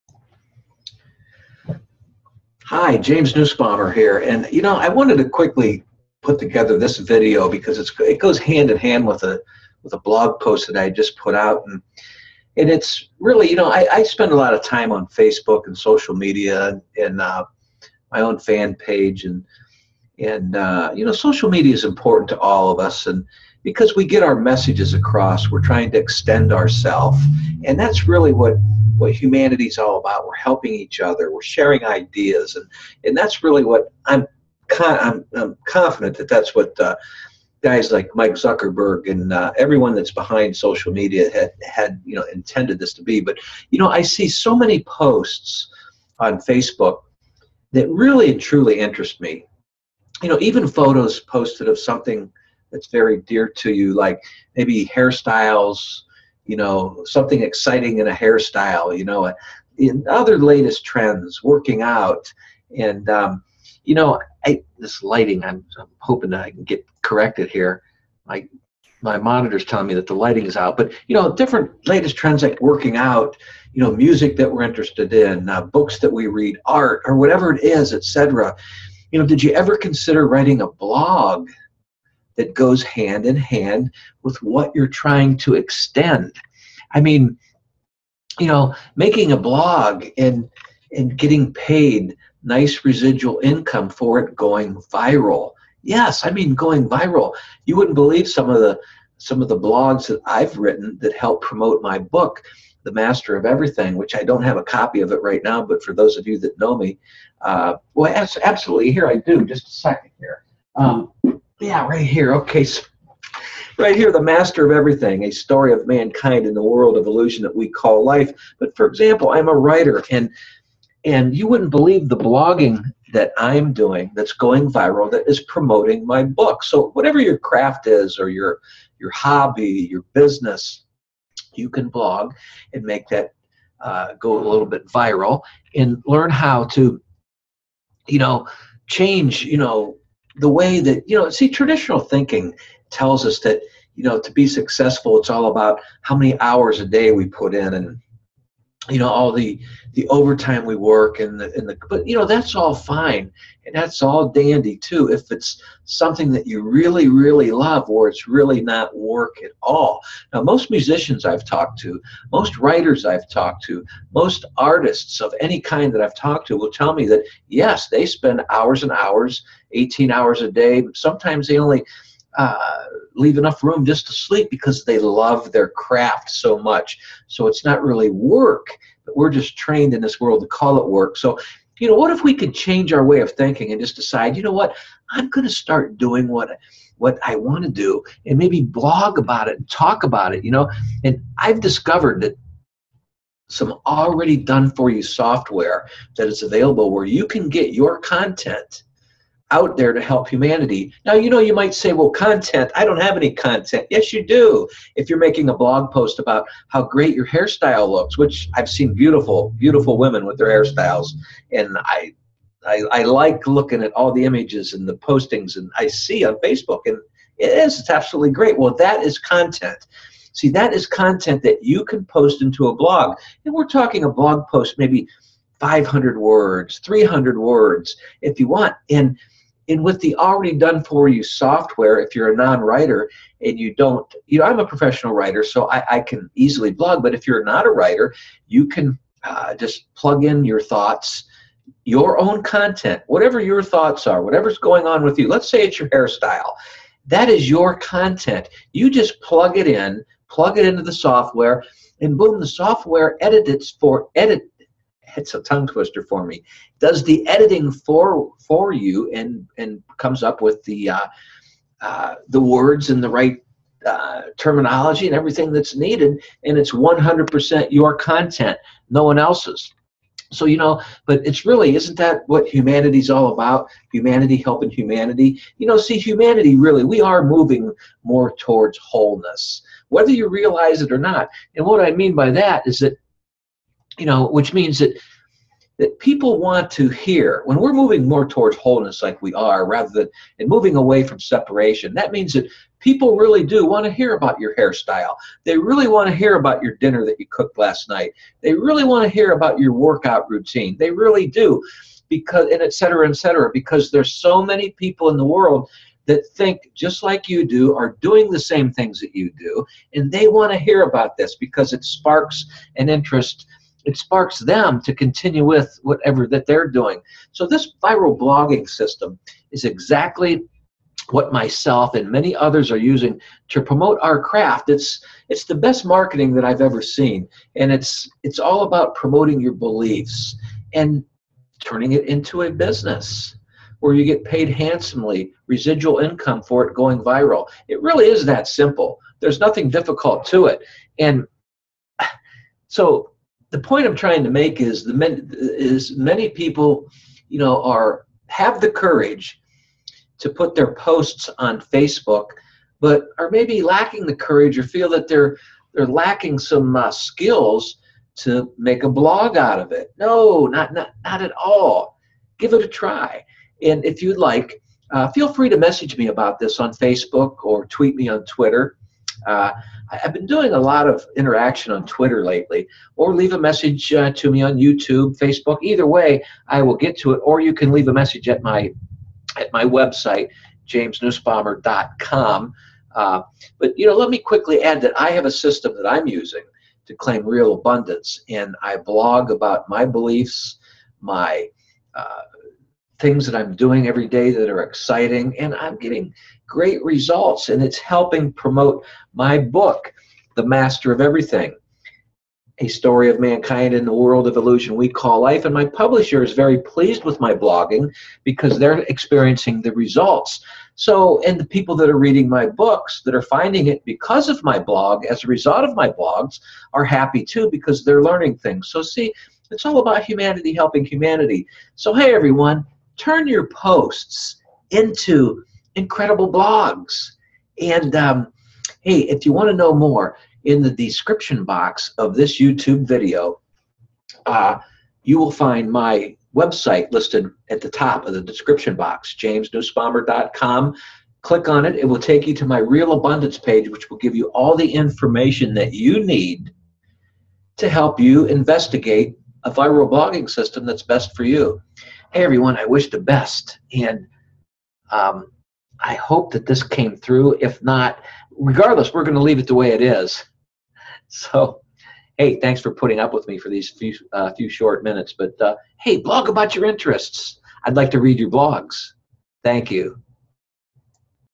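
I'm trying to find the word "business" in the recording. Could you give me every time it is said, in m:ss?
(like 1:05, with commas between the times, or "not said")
2:10, 5:32.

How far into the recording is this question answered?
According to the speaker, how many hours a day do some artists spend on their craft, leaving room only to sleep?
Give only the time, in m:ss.
2:49.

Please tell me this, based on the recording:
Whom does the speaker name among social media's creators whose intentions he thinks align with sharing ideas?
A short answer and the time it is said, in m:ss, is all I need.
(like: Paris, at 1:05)
Mike Zuckerberg, at 0:38.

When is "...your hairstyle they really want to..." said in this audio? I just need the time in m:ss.
4:54.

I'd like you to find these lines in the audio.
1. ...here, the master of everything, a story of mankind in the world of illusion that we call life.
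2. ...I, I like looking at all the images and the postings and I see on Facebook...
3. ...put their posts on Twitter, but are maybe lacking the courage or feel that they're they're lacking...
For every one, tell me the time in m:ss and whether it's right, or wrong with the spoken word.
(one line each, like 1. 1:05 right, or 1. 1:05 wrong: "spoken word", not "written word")
1. 1:53 right
2. 3:32 right
3. 5:50 wrong: "Facebook", not "Twitter".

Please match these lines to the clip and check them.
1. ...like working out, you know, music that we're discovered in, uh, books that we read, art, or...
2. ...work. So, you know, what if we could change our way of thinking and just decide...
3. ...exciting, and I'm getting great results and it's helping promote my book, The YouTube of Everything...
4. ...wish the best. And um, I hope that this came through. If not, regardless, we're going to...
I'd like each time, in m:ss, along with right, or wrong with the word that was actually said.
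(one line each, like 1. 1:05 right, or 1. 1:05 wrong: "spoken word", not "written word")
1. 1:12 wrong: "interested", not "discovered"
2. 3:00 right
3. 6:34 wrong: "Master", not "YouTube"
4. 7:32 right.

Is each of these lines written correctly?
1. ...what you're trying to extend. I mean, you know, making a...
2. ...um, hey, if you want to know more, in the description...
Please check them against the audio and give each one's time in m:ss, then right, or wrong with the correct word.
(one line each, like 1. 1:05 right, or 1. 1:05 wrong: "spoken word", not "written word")
1. 1:24 right
2. 7:07 right.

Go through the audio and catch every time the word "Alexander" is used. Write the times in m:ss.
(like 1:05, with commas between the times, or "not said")
not said.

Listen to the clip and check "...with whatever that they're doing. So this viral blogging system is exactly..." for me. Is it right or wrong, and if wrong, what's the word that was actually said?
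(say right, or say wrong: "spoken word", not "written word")
right.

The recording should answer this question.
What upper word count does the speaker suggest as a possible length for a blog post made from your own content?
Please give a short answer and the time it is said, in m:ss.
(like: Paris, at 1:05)
500 words, at 3:45.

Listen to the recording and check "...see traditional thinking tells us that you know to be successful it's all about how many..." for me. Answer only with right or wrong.
right.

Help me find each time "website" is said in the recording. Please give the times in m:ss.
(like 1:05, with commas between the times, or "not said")
6:19, 7:16.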